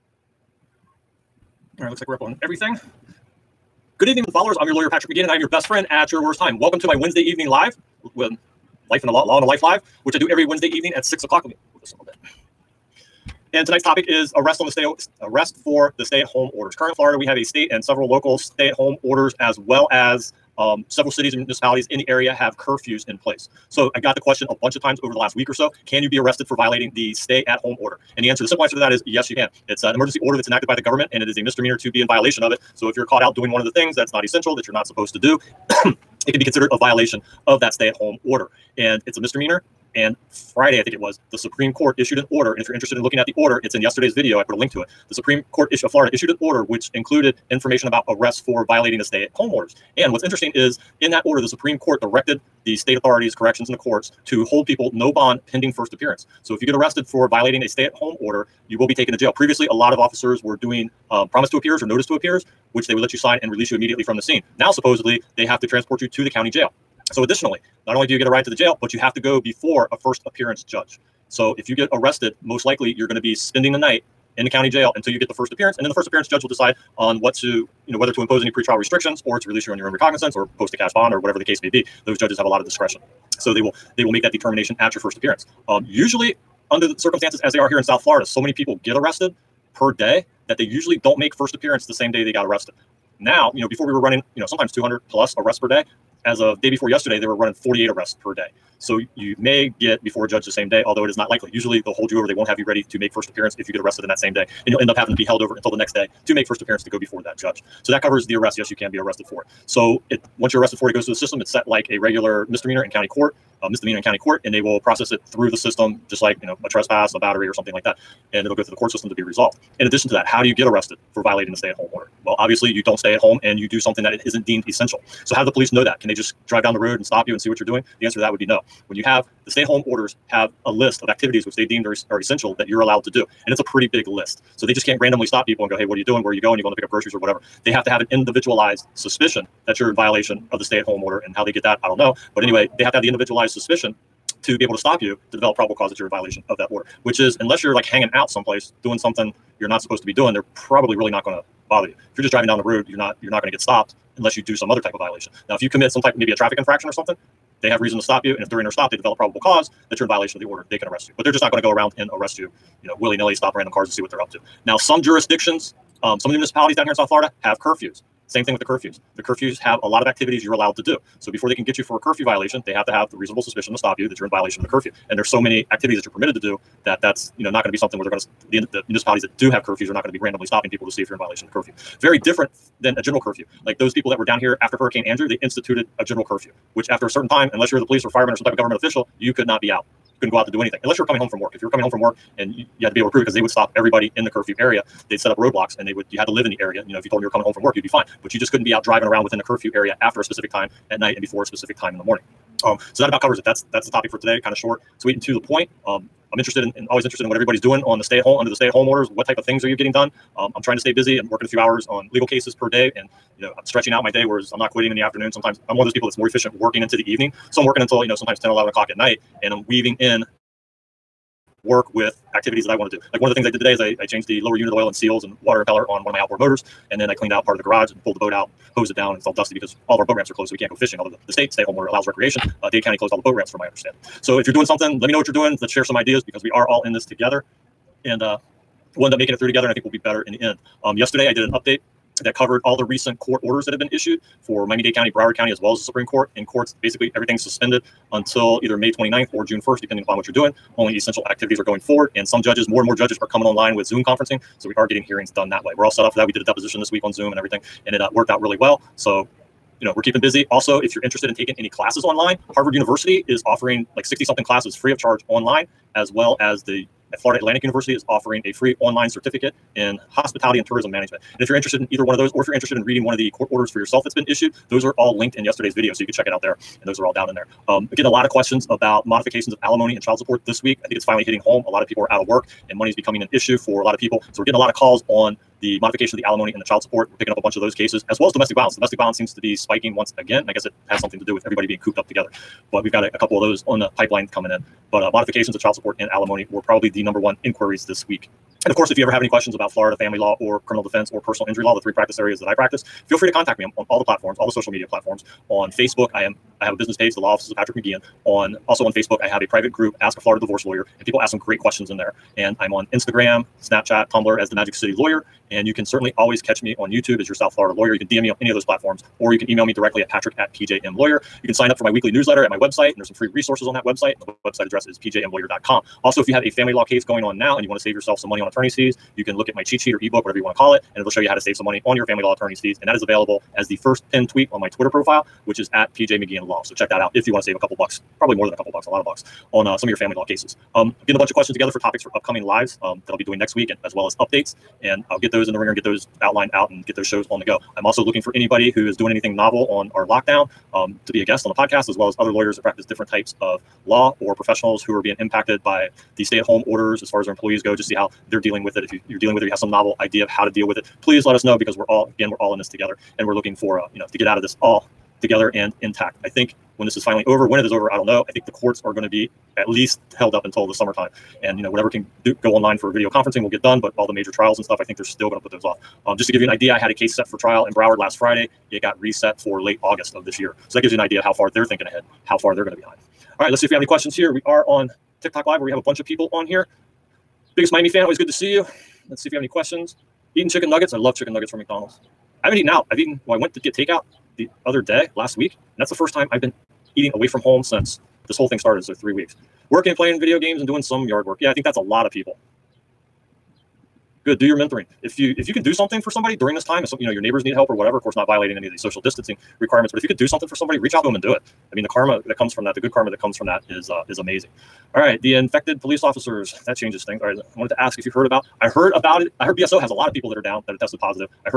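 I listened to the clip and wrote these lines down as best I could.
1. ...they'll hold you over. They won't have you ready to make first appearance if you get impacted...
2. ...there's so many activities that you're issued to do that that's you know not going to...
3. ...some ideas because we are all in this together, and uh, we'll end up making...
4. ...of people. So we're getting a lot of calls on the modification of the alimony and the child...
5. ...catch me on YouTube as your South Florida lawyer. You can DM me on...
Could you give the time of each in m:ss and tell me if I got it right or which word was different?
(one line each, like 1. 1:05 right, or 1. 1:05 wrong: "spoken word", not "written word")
1. 1:41 wrong: "arrested", not "impacted"
2. 2:55 wrong: "permitted", not "issued"
3. 3:55 right
4. 4:43 right
5. 5:16 right.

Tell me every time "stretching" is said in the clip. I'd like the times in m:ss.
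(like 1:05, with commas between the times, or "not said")
3:33.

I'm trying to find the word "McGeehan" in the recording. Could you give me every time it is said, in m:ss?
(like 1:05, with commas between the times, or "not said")
0:05, 5:07.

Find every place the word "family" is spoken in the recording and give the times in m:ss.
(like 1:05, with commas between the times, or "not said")
4:59, 5:26, 5:32, 5:39.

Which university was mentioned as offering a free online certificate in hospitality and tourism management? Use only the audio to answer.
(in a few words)
Florida Atlantic University.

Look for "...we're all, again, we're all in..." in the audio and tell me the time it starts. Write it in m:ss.
6:01.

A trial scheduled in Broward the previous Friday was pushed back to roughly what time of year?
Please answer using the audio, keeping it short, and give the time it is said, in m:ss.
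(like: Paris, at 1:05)
late August, at 6:19.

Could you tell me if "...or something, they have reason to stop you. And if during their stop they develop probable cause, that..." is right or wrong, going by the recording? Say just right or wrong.
right.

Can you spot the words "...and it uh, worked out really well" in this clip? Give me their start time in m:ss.
4:17.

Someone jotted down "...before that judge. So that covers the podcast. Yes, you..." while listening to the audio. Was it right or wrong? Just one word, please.
wrong.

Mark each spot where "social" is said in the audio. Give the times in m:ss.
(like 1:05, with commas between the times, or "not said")
5:04, 6:48.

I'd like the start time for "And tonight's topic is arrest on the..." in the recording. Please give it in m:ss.
0:13.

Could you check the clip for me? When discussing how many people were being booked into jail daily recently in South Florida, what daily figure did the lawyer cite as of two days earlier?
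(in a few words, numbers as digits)
48.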